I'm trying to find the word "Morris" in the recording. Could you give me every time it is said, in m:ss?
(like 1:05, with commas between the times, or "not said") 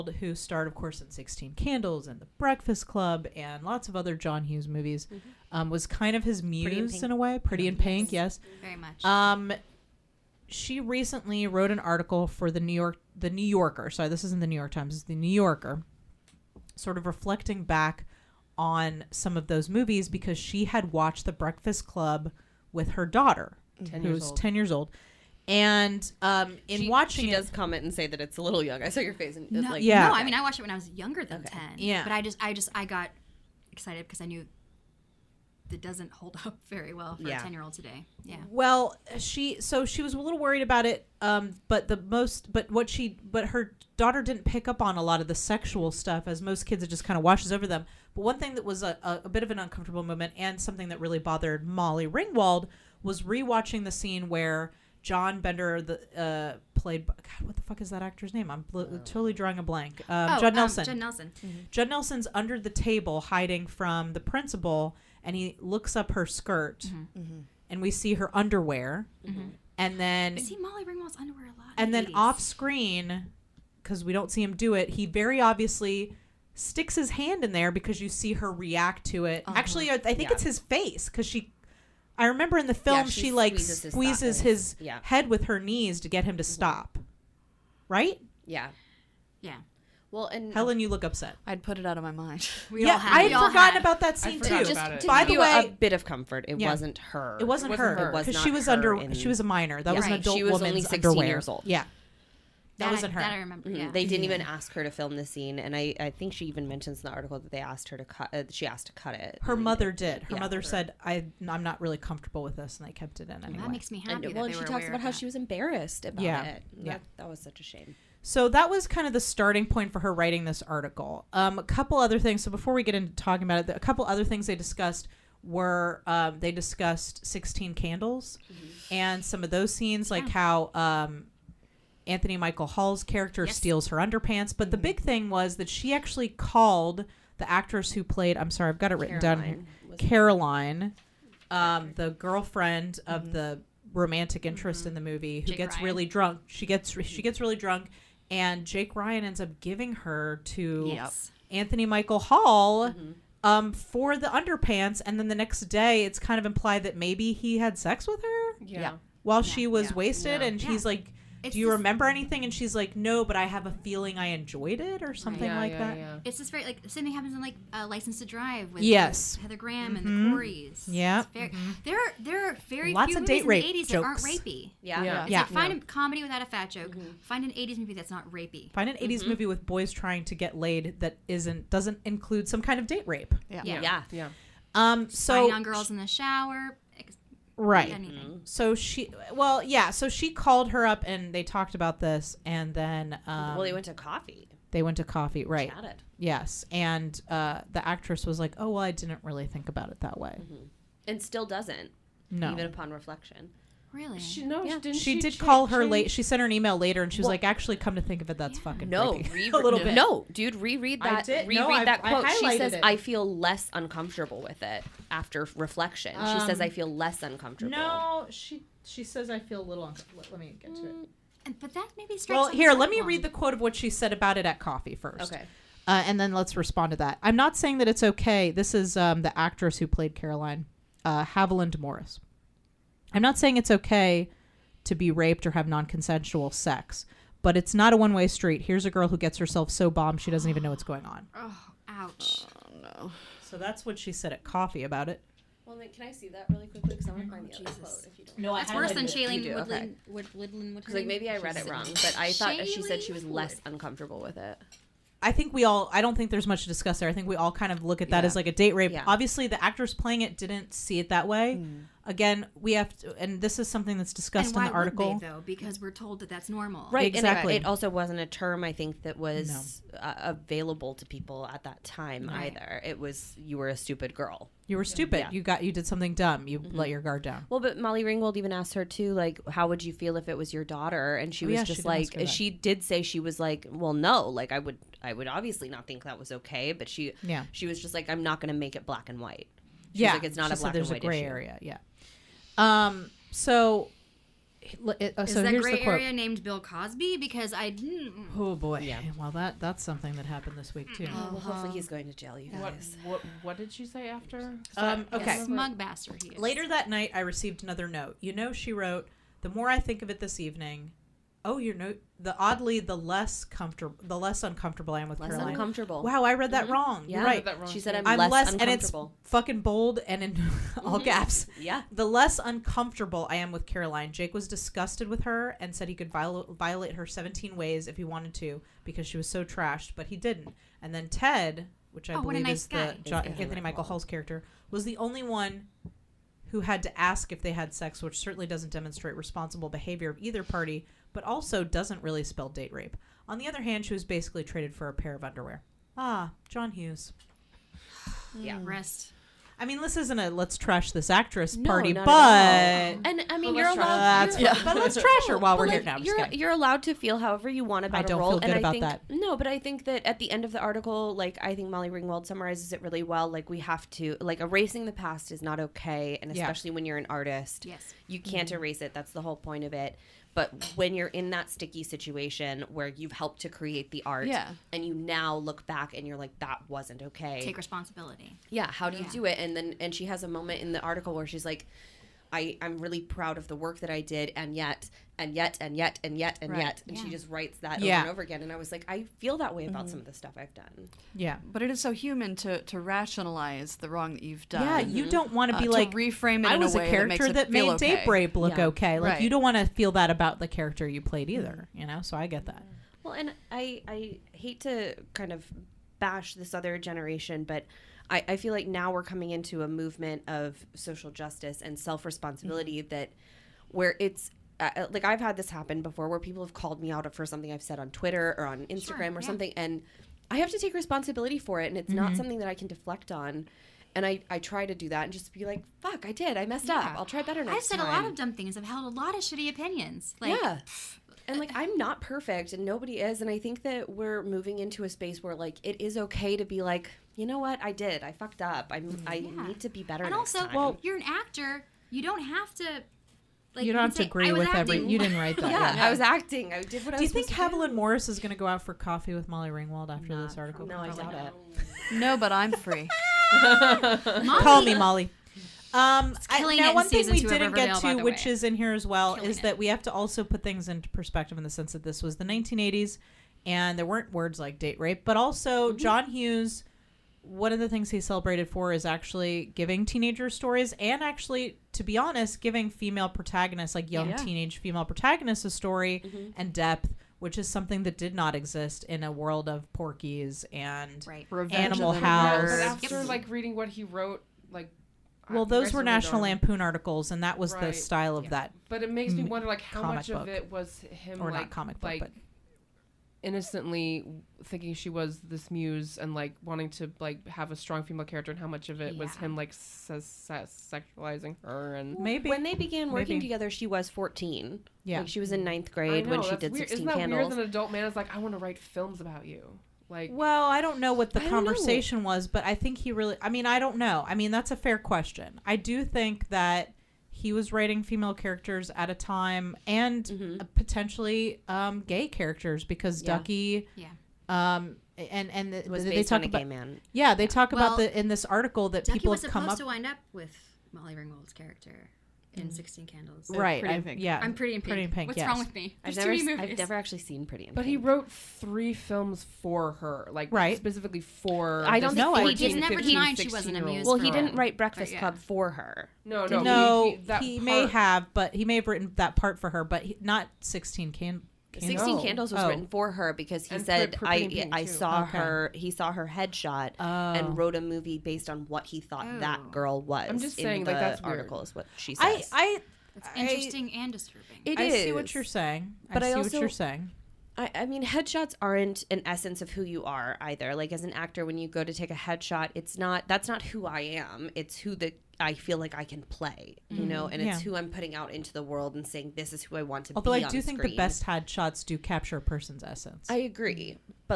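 3:51, 7:27.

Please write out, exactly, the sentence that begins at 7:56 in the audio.
and depth which is something that did not exist in a world of Porky's and right.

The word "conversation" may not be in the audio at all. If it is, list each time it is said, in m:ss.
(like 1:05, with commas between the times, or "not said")
8:31.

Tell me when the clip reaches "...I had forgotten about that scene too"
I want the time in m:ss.
1:33.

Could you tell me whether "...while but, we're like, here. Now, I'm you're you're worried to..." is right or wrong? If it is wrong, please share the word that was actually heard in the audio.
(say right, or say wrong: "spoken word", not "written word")
wrong: "allowed", not "worried".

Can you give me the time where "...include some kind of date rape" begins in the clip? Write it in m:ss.
3:02.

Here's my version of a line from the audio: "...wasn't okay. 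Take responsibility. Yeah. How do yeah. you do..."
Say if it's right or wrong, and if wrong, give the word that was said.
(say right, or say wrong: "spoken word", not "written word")
right.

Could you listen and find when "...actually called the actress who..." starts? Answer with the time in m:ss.
2:15.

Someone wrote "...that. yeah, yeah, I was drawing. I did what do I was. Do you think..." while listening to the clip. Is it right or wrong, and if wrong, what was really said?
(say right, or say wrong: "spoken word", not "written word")
wrong: "acting", not "drawing".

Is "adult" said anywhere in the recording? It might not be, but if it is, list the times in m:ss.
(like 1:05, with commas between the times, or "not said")
1:40, 8:27.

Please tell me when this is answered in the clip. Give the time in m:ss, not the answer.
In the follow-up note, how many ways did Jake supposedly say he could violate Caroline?
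5:27.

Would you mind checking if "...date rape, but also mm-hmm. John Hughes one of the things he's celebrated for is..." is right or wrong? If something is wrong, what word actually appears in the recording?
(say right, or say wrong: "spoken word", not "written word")
right.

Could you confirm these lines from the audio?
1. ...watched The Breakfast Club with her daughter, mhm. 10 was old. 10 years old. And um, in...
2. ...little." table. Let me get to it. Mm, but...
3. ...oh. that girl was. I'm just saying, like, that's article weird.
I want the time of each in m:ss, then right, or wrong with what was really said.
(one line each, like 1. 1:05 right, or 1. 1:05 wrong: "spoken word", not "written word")
1. 0:20 right
2. 3:39 wrong: "uncomfortable", not "table"
3. 9:19 right.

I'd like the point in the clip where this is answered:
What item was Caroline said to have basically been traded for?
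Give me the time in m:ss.
5:44.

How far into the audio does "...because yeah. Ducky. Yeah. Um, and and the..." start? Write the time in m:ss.
8:42.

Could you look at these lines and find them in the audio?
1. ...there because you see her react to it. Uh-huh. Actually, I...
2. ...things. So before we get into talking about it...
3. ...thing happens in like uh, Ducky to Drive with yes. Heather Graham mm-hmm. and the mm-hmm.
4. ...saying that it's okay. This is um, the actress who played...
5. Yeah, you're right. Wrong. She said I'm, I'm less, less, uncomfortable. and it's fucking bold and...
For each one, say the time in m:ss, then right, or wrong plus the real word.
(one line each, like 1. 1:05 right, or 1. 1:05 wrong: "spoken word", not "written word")
1. 1:17 right
2. 2:02 right
3. 2:47 wrong: "License", not "Ducky"
4. 3:47 right
5. 5:17 right.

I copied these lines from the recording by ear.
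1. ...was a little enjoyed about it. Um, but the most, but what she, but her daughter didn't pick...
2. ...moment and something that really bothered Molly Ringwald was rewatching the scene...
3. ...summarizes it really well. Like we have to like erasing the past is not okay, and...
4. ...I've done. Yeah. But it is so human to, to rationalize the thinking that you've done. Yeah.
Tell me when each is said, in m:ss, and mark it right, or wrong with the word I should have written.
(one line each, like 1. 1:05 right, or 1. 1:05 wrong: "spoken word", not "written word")
1. 0:40 wrong: "worried", not "enjoyed"
2. 0:50 right
3. 6:02 right
4. 6:30 wrong: "wrong", not "thinking".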